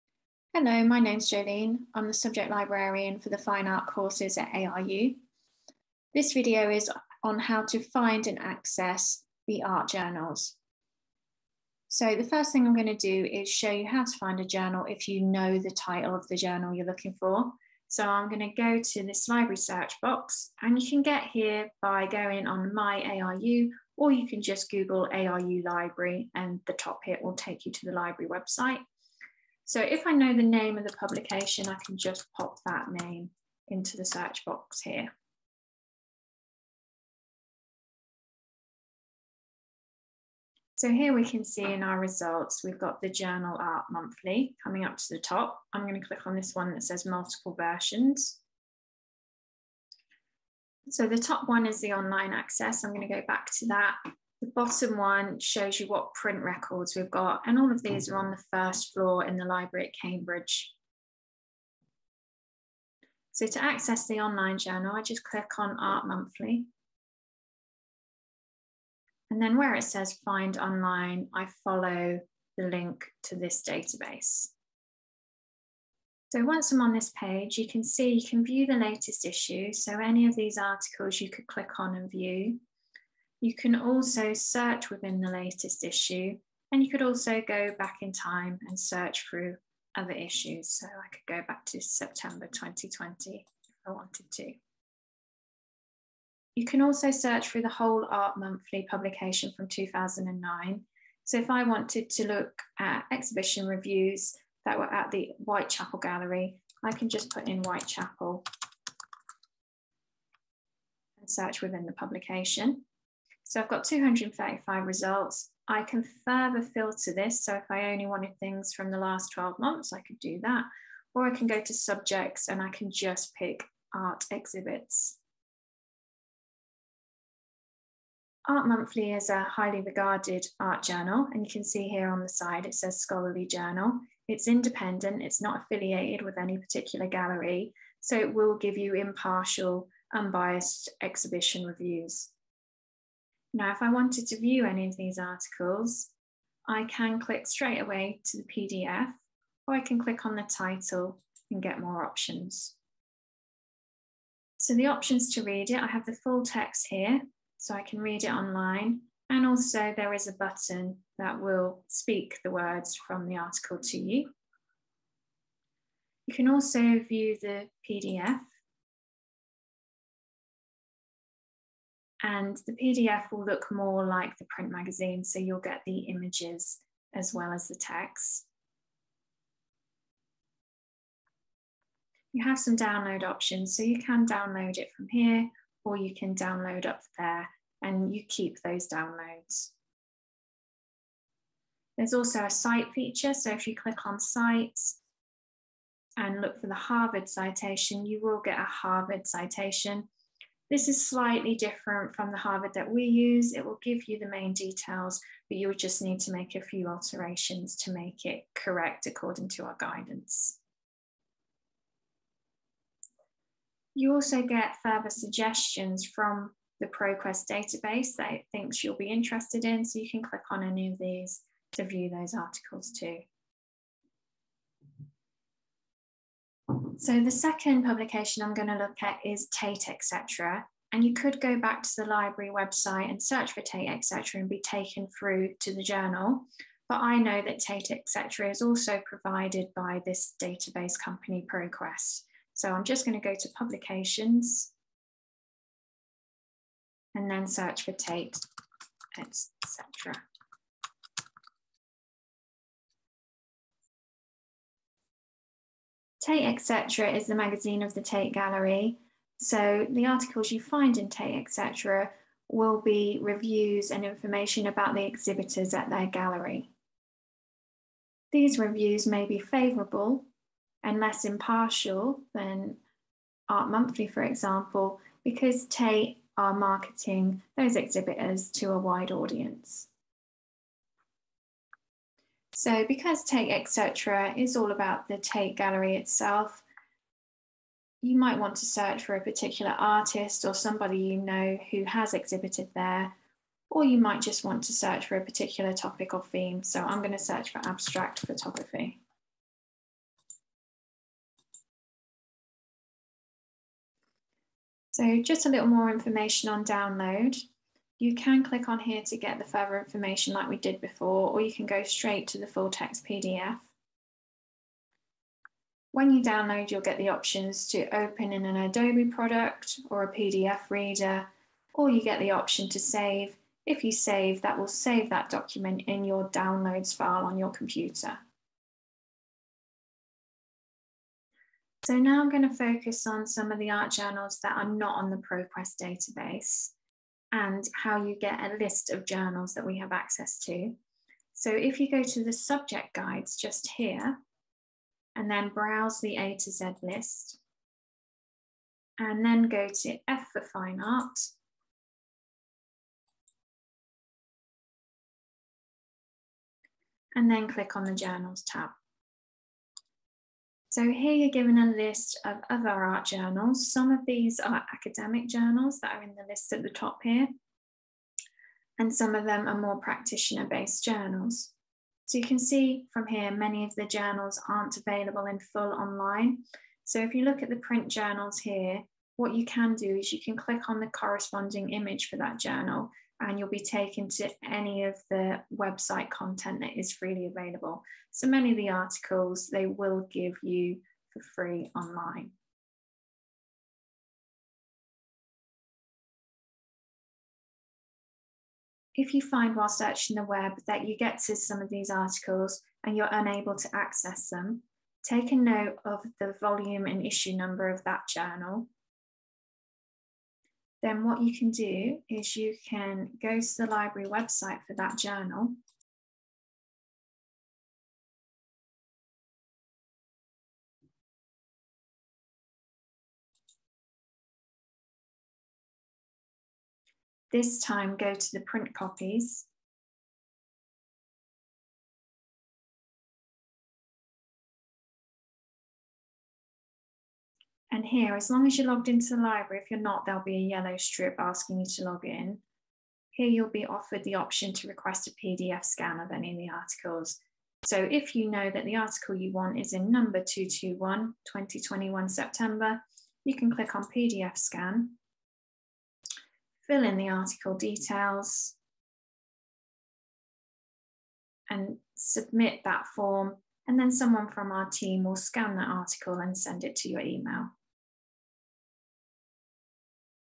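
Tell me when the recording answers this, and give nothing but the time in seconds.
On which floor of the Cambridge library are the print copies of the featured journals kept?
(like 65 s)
58 s.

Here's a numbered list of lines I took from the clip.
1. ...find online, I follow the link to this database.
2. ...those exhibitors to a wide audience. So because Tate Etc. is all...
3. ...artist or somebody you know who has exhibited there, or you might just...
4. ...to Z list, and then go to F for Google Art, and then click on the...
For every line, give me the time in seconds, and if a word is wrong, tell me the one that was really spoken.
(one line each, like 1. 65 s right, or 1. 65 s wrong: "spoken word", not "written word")
1. 70 s right
2. 277 s right
3. 289 s right
4. 346 s wrong: "Fine", not "Google".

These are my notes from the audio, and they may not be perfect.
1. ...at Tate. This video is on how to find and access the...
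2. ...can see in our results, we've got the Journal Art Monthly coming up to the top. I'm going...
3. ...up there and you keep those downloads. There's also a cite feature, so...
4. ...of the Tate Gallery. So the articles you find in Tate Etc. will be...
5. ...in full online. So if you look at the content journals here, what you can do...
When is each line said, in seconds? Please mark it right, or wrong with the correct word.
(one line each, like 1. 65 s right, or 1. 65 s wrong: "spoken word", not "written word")
1. 4 s wrong: "ARU", not "Tate"
2. 41 s right
3. 186 s right
4. 257 s right
5. 375 s wrong: "print", not "content".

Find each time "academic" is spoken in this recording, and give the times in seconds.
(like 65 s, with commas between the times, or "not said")
364 s.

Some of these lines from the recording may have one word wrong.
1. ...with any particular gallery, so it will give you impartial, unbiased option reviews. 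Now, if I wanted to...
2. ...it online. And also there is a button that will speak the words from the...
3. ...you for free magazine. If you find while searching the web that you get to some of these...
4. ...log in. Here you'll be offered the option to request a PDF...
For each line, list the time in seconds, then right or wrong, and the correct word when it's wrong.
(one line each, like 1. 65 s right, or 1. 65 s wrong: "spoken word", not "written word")
1. 136 s wrong: "exhibition", not "option"
2. 158 s right
3. 390 s wrong: "online", not "magazine"
4. 441 s right.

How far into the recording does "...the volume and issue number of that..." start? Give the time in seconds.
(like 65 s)
406 s.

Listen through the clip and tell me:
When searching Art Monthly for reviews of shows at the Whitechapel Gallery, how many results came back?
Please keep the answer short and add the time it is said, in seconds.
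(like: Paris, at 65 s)
235, at 113 s.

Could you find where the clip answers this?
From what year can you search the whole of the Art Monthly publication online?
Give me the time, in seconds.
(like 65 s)
99 s.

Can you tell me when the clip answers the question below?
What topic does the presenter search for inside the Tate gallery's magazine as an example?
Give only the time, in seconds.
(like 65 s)
297 s.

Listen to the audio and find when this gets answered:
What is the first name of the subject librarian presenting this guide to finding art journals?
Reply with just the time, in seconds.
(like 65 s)
1 s.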